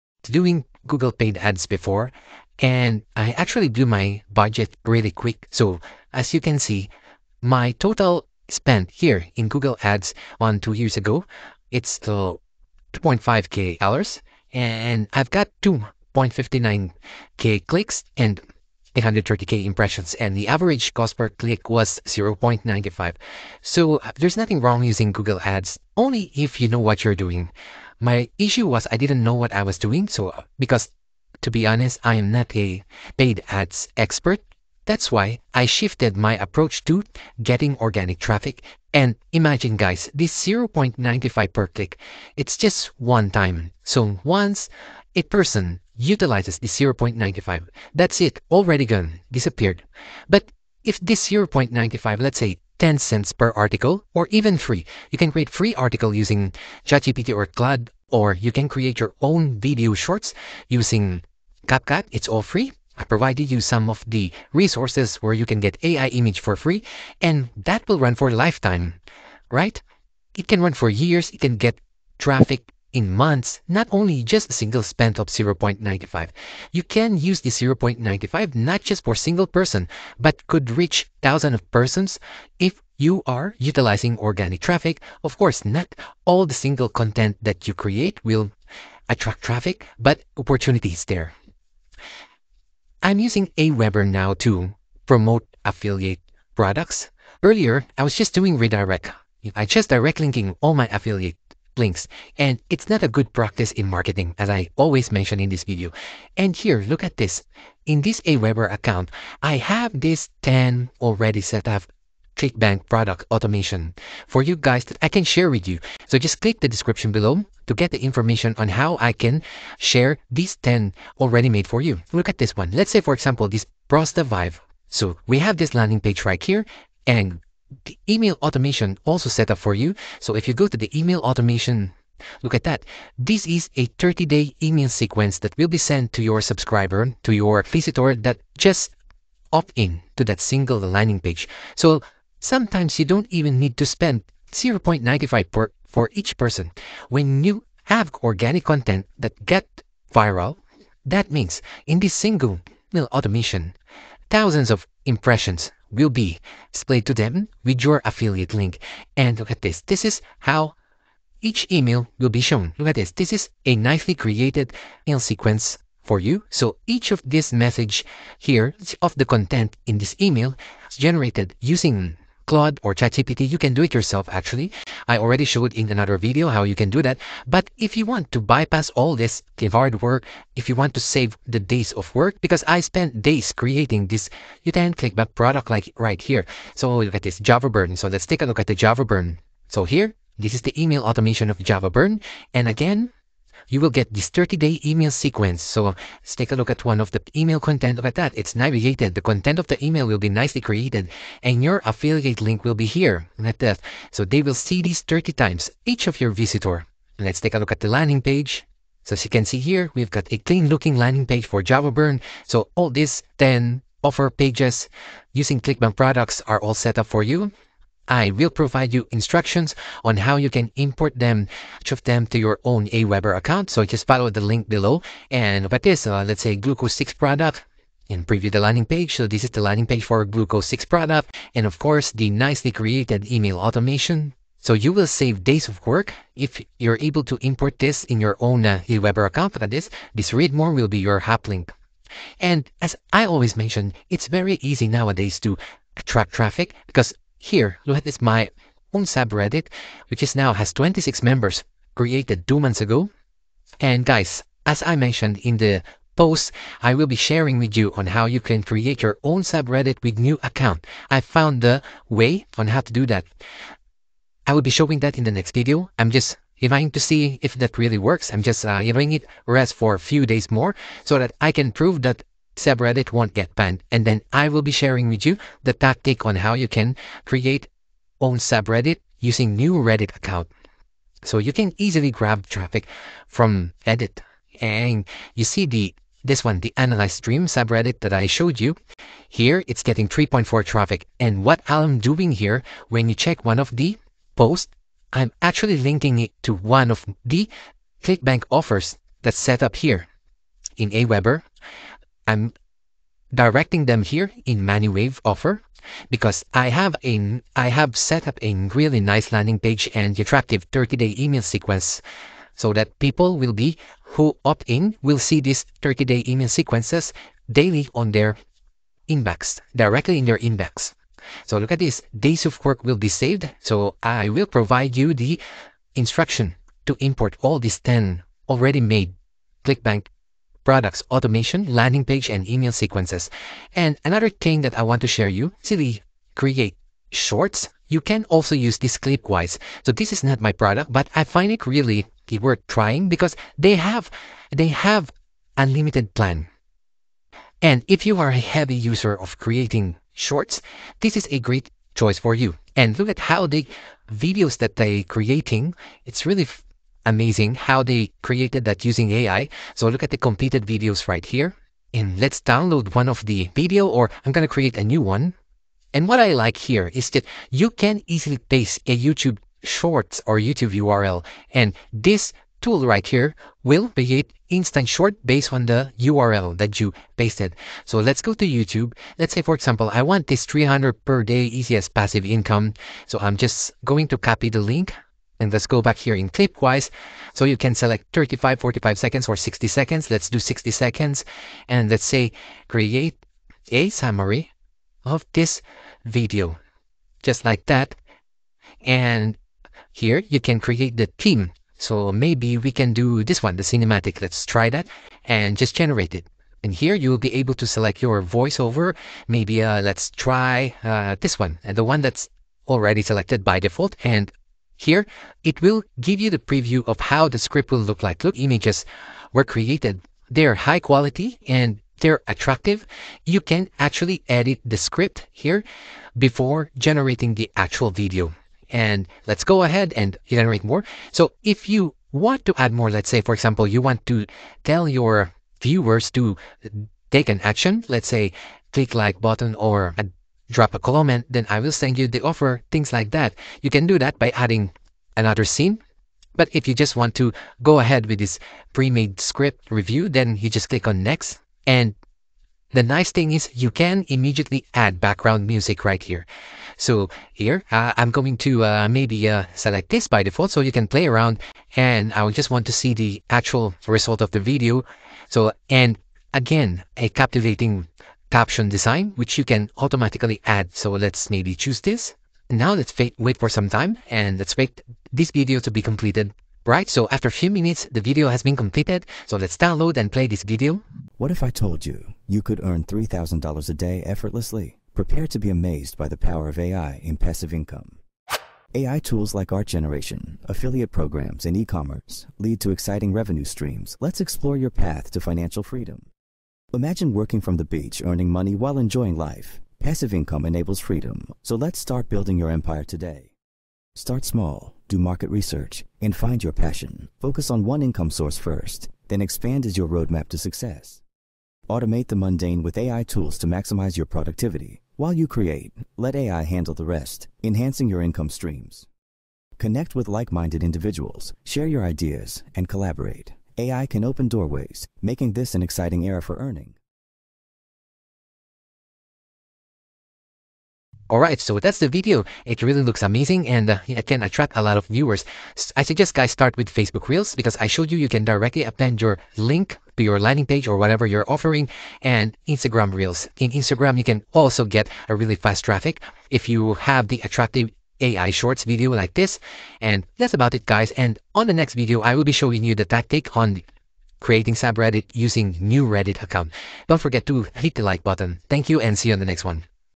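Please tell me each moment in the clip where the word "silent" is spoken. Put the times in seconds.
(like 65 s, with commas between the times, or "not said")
not said.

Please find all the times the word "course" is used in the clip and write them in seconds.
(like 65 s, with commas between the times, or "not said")
85 s, 231 s.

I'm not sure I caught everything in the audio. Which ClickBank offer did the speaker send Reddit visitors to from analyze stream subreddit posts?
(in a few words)
ManuWave.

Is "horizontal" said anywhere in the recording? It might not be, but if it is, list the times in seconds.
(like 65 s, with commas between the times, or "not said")
not said.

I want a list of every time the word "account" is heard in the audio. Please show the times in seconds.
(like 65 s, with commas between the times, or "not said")
108 s, 223 s, 239 s, 260 s, 280 s, 556 s.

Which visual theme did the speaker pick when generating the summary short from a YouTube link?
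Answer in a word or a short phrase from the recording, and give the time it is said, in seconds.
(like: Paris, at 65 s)
Cinematic, at 403 s.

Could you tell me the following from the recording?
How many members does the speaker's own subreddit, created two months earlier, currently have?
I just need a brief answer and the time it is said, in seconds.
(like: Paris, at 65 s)
26, at 250 s.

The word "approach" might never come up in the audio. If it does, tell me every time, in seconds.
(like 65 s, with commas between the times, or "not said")
36 s.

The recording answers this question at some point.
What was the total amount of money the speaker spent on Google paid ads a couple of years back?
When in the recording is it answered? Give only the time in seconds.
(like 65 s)
12 s.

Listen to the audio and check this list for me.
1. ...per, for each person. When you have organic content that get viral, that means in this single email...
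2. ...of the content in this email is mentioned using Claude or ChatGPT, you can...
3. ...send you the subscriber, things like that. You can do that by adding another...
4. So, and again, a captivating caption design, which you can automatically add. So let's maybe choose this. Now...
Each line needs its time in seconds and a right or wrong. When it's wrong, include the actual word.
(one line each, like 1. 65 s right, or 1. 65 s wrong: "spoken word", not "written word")
1. 145 s right
2. 169 s wrong: "generated", not "mentioned"
3. 441 s wrong: "offer", not "subscriber"
4. 465 s right.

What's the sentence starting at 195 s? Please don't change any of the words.
So um, let's take a look at one of the email content of that.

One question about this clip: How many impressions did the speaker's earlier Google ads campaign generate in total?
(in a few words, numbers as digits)
830k.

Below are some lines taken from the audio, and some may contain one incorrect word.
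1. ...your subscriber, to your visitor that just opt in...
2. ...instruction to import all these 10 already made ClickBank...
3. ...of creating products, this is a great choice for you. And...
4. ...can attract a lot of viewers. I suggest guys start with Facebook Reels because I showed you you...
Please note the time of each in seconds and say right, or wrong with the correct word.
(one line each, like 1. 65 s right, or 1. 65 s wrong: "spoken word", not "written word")
1. 136 s right
2. 325 s right
3. 349 s wrong: "shorts", not "products"
4. 534 s right.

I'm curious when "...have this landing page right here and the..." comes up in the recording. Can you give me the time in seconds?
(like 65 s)
125 s.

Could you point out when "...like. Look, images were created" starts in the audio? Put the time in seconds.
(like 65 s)
418 s.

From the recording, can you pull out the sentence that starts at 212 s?
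So all these 10 offer pages using ClickBank products are all set up for you.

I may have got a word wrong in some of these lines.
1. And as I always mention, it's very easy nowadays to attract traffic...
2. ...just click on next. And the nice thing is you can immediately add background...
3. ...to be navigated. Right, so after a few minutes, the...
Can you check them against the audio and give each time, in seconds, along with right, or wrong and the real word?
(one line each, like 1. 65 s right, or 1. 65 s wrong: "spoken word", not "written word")
1. 242 s right
2. 450 s right
3. 475 s wrong: "completed", not "navigated".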